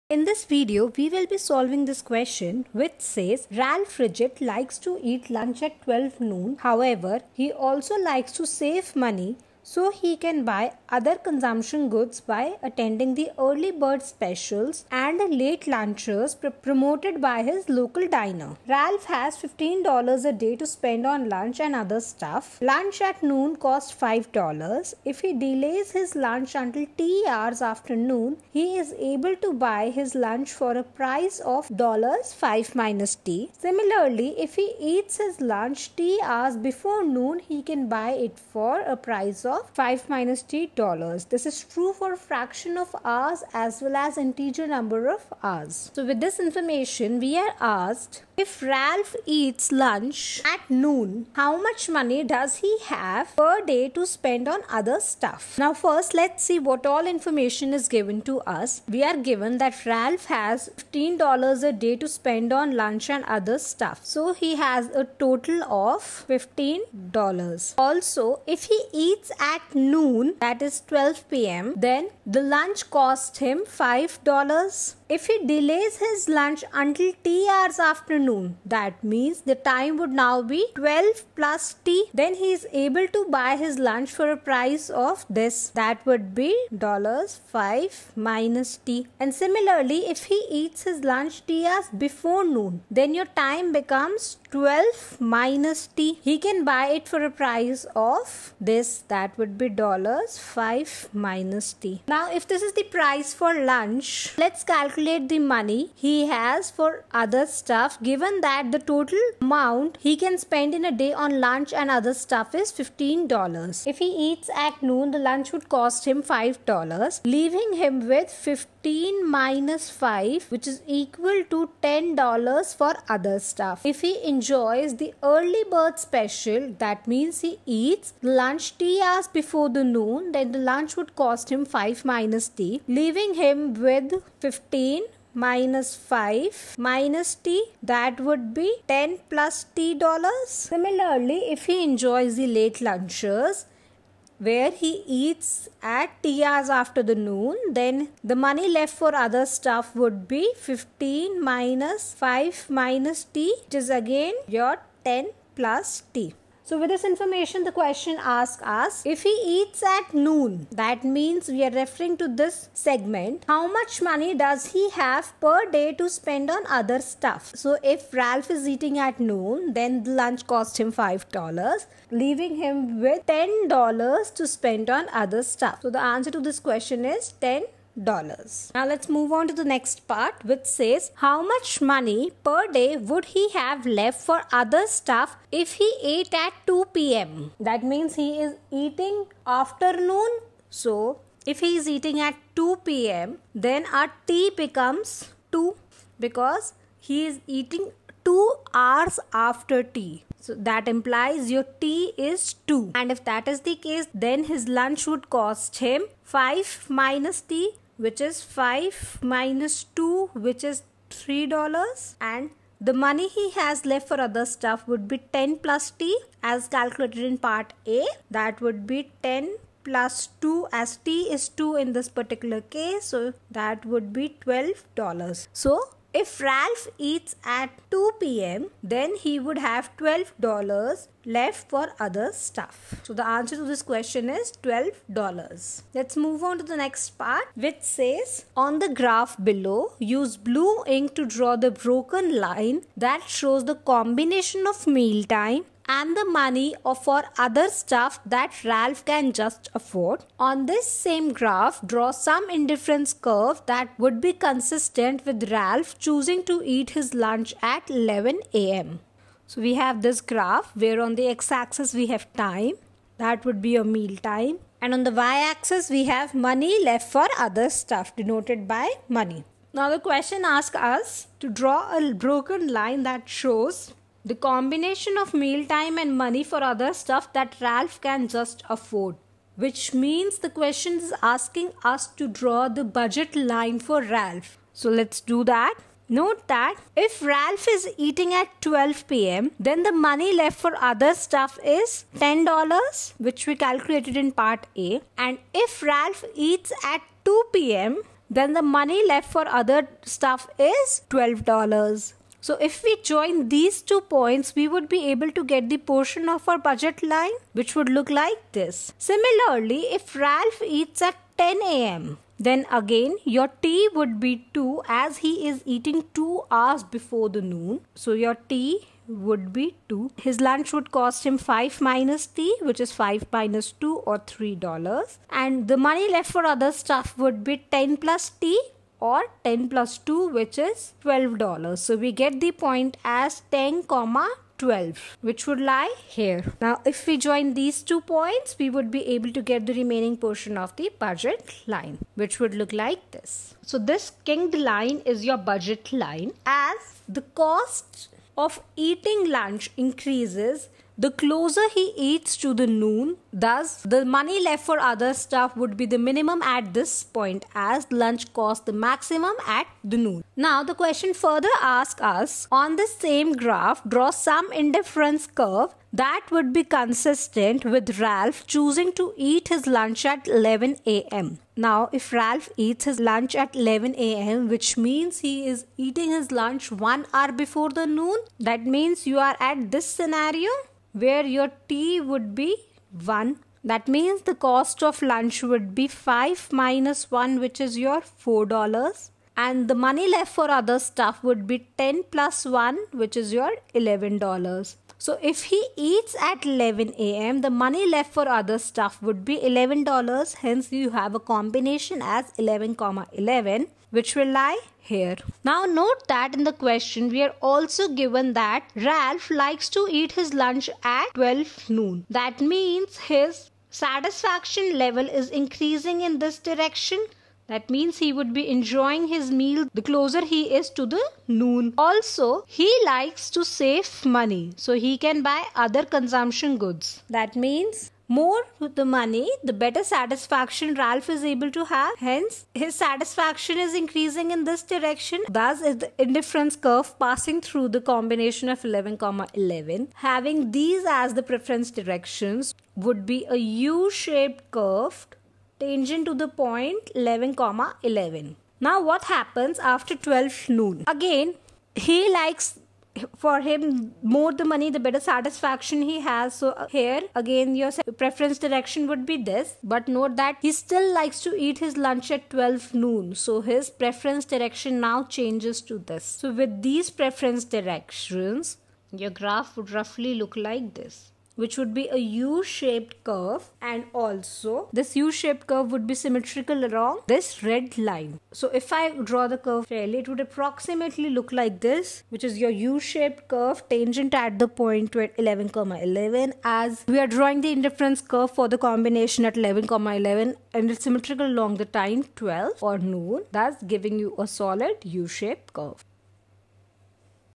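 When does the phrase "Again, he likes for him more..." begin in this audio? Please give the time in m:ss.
7:30.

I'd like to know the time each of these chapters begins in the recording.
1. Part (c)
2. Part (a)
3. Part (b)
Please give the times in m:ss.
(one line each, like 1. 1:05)
1. 3:56
2. 0:47
3. 2:59.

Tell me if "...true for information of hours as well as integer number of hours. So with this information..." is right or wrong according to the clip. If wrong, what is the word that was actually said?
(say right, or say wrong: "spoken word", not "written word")
wrong: "fraction", not "information".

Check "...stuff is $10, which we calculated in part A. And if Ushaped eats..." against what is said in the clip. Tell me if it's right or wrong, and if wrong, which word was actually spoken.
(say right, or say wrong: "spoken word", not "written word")
wrong: "Ralph", not "Ushaped".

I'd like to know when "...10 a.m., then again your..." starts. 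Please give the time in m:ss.
5:11.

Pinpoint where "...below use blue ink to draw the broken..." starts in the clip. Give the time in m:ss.
3:59.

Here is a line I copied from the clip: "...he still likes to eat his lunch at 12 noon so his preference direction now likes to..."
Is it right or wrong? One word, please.
wrong.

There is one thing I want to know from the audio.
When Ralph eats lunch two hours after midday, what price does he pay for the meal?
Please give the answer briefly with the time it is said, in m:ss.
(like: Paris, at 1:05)
$3, at 3:28.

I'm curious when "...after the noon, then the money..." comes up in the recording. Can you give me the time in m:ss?
2:26.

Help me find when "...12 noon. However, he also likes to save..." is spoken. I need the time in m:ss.
0:05.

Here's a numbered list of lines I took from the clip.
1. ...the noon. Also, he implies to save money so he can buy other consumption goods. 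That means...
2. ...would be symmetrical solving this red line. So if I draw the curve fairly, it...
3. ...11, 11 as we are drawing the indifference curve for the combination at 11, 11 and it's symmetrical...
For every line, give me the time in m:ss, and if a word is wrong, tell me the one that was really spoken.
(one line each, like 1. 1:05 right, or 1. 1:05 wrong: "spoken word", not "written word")
1. 7:00 wrong: "likes", not "implies"
2. 7:55 wrong: "along", not "solving"
3. 8:05 right.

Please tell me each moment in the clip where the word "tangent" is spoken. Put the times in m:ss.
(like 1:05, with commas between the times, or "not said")
7:25, 8:03.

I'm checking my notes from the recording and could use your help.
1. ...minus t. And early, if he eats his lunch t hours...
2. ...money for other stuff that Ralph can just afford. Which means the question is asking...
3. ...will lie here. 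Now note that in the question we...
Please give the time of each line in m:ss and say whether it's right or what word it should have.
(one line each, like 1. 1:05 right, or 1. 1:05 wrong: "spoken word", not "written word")
1. 1:28 wrong: "similarly", not "early"
2. 4:36 right
3. 6:44 right.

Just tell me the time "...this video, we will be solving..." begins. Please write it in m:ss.
0:00.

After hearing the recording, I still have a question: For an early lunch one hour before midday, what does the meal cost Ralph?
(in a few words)
$4.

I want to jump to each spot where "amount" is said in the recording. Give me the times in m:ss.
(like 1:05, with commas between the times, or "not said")
1:49.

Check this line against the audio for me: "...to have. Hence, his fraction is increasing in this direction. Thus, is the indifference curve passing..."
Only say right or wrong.
wrong.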